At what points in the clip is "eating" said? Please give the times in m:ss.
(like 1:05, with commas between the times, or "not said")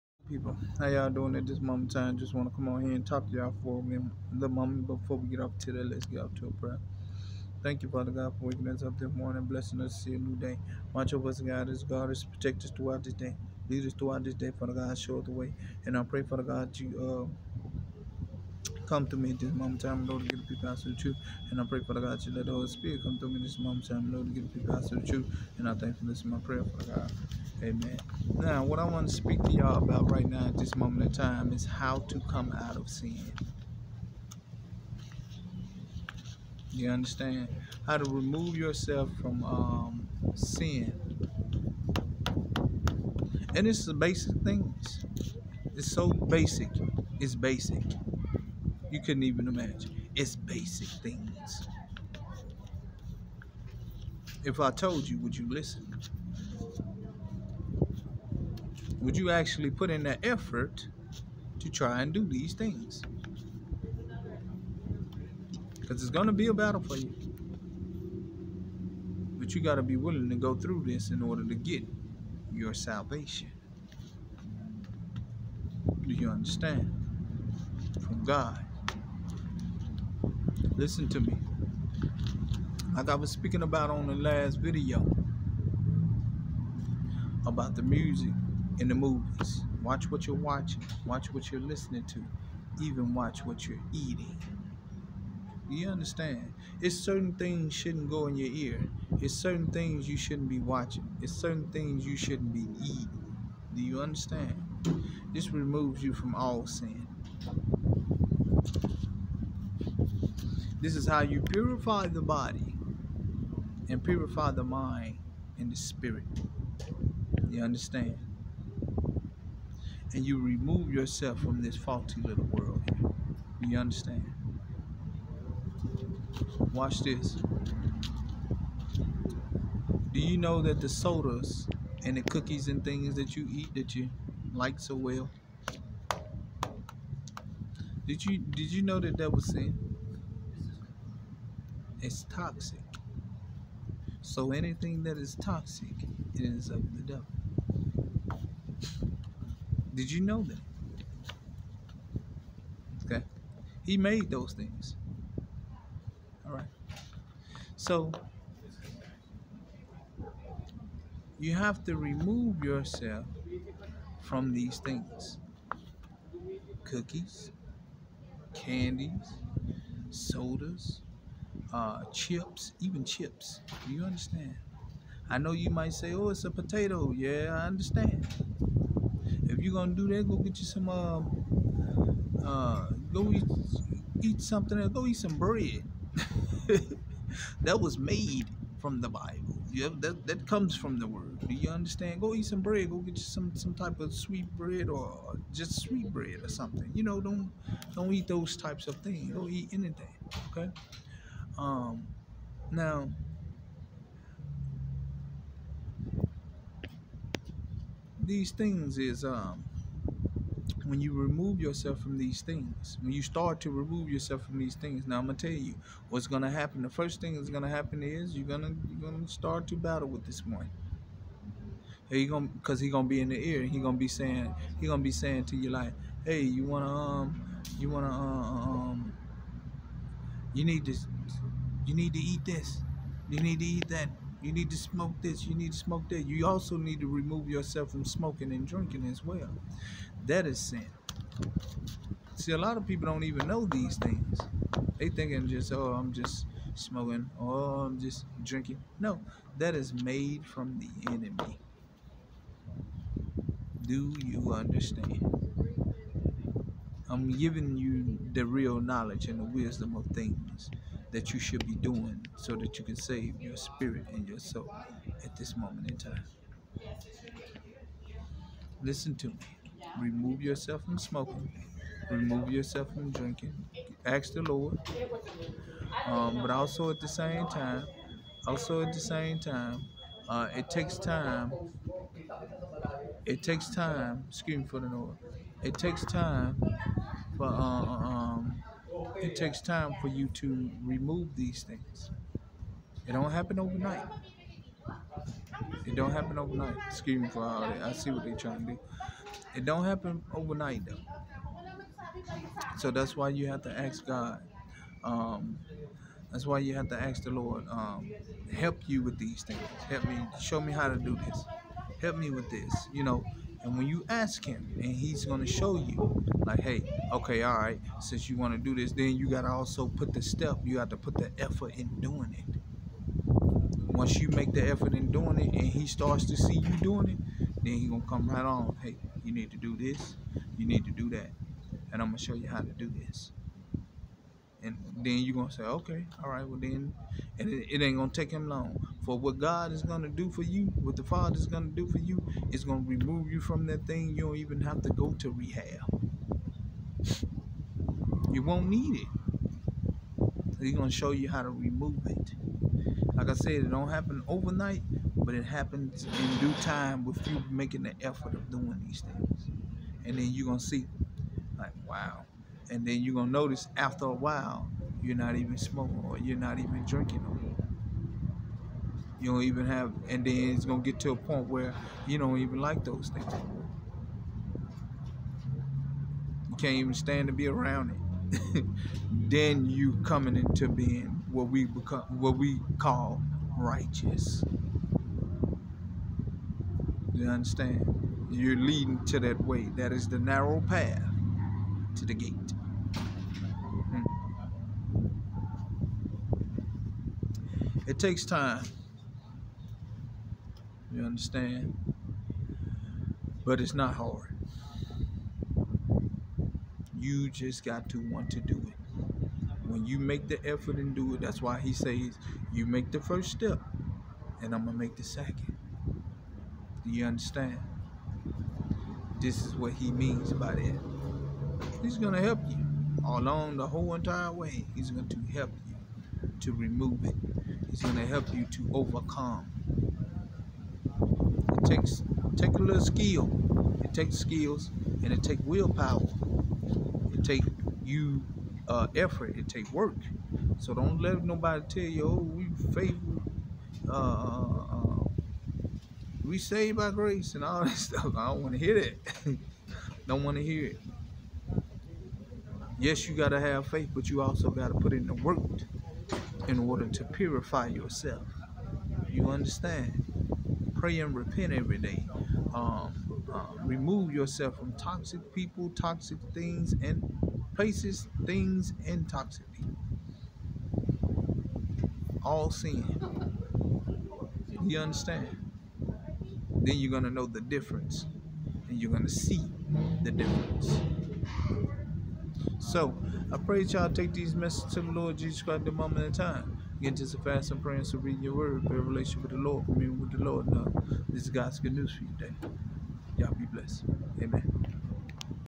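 1:33, 1:42.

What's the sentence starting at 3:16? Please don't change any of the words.
You know, don't don't eat those types of things.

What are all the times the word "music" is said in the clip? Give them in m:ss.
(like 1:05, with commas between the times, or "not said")
1:27.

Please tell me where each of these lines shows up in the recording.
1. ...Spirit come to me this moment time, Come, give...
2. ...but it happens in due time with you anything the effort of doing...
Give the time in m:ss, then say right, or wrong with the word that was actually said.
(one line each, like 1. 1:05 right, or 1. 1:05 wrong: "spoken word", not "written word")
1. 0:22 wrong: "Lord", not "Come"
2. 5:55 wrong: "making", not "anything".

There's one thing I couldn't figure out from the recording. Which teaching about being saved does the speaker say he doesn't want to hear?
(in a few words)
Saved by grace.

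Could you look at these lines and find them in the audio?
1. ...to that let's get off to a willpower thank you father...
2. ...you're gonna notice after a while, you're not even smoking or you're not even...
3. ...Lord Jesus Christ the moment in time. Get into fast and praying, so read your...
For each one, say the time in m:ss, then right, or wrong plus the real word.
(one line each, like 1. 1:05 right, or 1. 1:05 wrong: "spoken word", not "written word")
1. 0:05 wrong: "prayer", not "willpower"
2. 6:03 right
3. 8:04 right.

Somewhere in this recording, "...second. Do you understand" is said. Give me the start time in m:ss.
6:55.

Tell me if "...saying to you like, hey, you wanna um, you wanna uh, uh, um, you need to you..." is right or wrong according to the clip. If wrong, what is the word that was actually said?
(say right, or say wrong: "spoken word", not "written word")
right.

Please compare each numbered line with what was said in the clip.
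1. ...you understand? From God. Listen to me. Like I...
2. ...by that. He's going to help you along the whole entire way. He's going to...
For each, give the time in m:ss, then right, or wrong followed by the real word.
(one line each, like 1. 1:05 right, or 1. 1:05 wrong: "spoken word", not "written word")
1. 1:16 right
2. 7:00 right.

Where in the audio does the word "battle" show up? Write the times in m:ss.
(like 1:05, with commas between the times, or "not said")
1:06, 3:39.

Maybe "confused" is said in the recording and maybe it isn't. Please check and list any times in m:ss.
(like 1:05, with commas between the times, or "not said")
not said.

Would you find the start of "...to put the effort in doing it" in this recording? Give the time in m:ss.
5:20.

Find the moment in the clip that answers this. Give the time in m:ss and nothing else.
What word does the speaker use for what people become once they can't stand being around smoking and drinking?
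6:23.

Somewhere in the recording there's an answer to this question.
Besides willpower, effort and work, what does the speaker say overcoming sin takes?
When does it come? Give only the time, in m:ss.
7:14.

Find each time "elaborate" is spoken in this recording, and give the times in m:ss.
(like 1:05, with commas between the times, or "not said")
not said.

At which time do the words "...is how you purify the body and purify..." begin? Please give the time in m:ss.
1:50.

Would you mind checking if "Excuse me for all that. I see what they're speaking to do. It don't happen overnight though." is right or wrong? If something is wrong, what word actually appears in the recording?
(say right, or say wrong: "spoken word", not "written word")
wrong: "trying", not "speaking".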